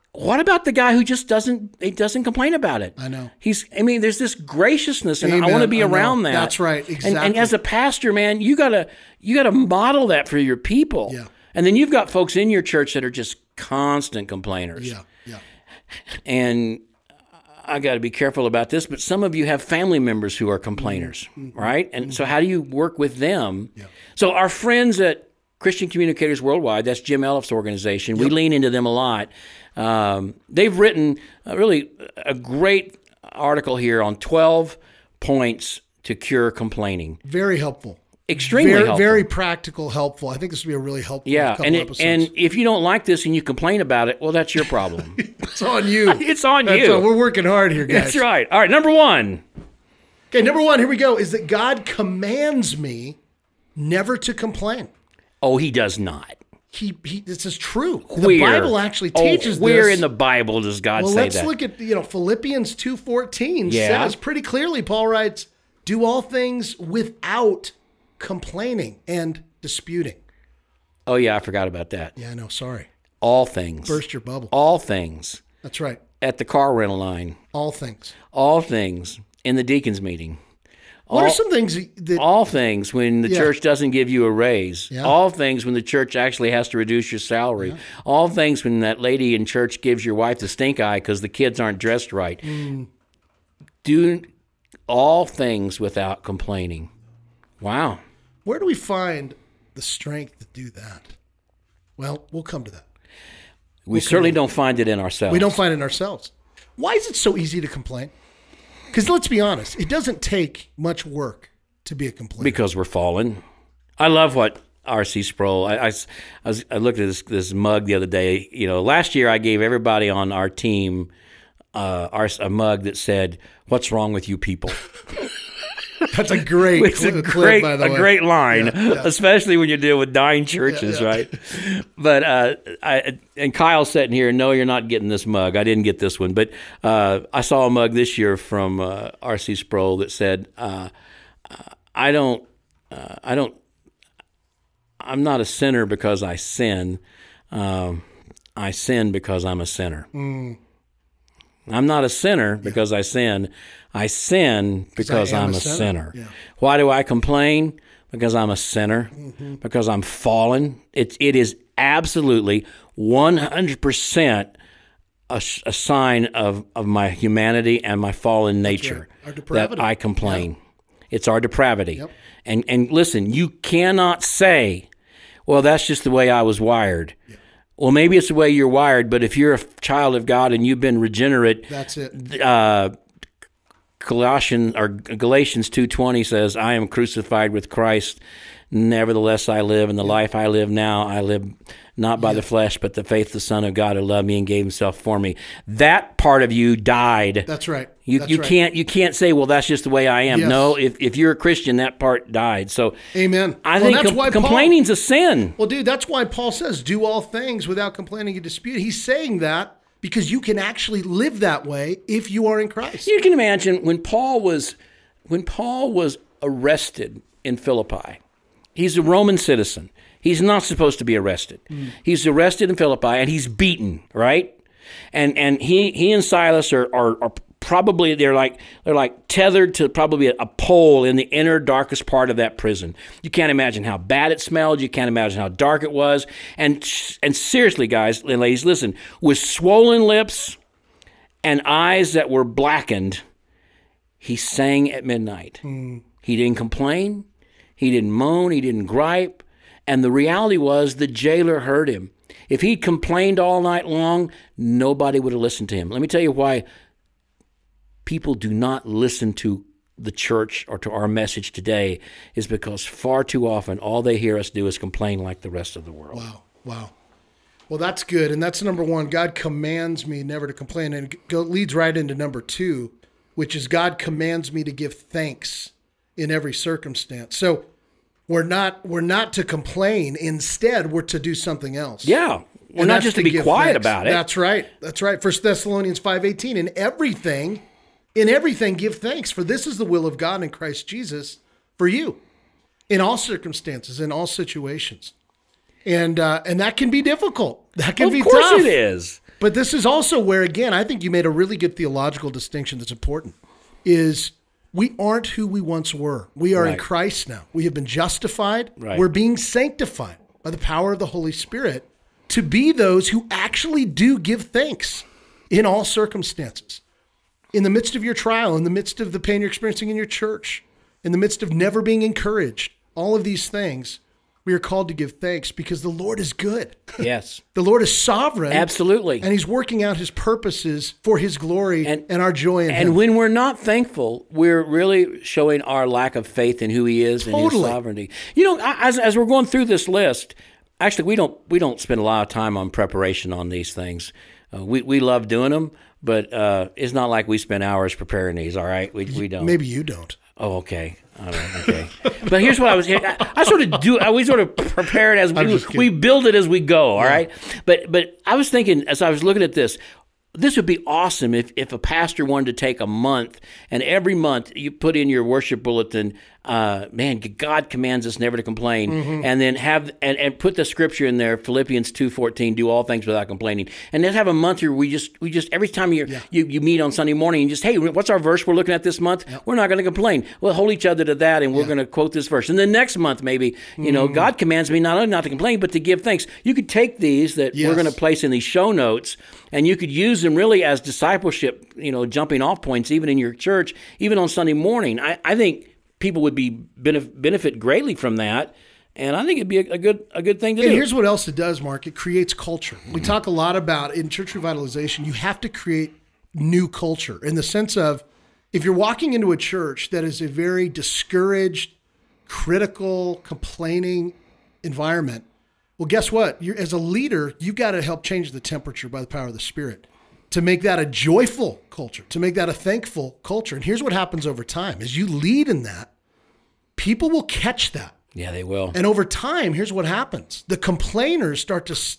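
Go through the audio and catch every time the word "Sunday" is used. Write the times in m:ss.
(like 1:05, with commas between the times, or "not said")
6:16, 6:34.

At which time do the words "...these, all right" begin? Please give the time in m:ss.
5:48.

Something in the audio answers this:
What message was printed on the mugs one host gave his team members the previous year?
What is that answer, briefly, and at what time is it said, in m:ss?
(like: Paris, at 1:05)
What's wrong with you people?, at 2:03.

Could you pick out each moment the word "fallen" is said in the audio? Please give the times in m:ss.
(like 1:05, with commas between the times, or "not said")
1:52, 2:40, 2:48.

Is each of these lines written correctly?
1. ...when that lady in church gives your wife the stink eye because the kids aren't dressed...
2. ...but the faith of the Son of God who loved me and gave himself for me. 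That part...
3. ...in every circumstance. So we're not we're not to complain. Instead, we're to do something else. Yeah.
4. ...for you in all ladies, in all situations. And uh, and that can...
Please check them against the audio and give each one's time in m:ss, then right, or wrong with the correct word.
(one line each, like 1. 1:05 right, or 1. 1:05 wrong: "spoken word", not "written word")
1. 1:28 right
2. 3:12 right
3. 4:36 right
4. 4:51 wrong: "circumstances", not "ladies".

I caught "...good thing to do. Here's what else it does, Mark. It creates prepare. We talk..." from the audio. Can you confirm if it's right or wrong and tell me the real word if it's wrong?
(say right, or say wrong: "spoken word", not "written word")
wrong: "culture", not "prepare".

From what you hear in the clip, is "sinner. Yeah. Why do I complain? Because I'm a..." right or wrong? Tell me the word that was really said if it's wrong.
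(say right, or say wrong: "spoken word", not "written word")
right.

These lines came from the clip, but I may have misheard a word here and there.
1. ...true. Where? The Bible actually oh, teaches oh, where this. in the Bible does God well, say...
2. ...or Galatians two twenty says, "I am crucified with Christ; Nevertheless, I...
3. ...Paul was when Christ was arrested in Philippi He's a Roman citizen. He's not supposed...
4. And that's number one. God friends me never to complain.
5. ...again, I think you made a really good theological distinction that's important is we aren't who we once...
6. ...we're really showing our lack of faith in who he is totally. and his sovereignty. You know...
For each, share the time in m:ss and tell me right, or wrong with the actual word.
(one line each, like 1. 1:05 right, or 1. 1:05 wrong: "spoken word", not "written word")
1. 0:57 right
2. 3:04 right
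3. 3:34 wrong: "Paul", not "Christ"
4. 4:28 wrong: "commands", not "friends"
5. 5:00 right
6. 5:34 right.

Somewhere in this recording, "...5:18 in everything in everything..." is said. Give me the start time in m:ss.
4:45.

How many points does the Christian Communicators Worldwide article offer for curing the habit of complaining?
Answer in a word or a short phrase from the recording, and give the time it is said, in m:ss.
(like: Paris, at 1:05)
12, at 0:34.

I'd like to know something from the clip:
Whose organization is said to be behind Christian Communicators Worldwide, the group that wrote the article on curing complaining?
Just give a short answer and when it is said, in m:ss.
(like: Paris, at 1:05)
Jim Elliff, at 0:26.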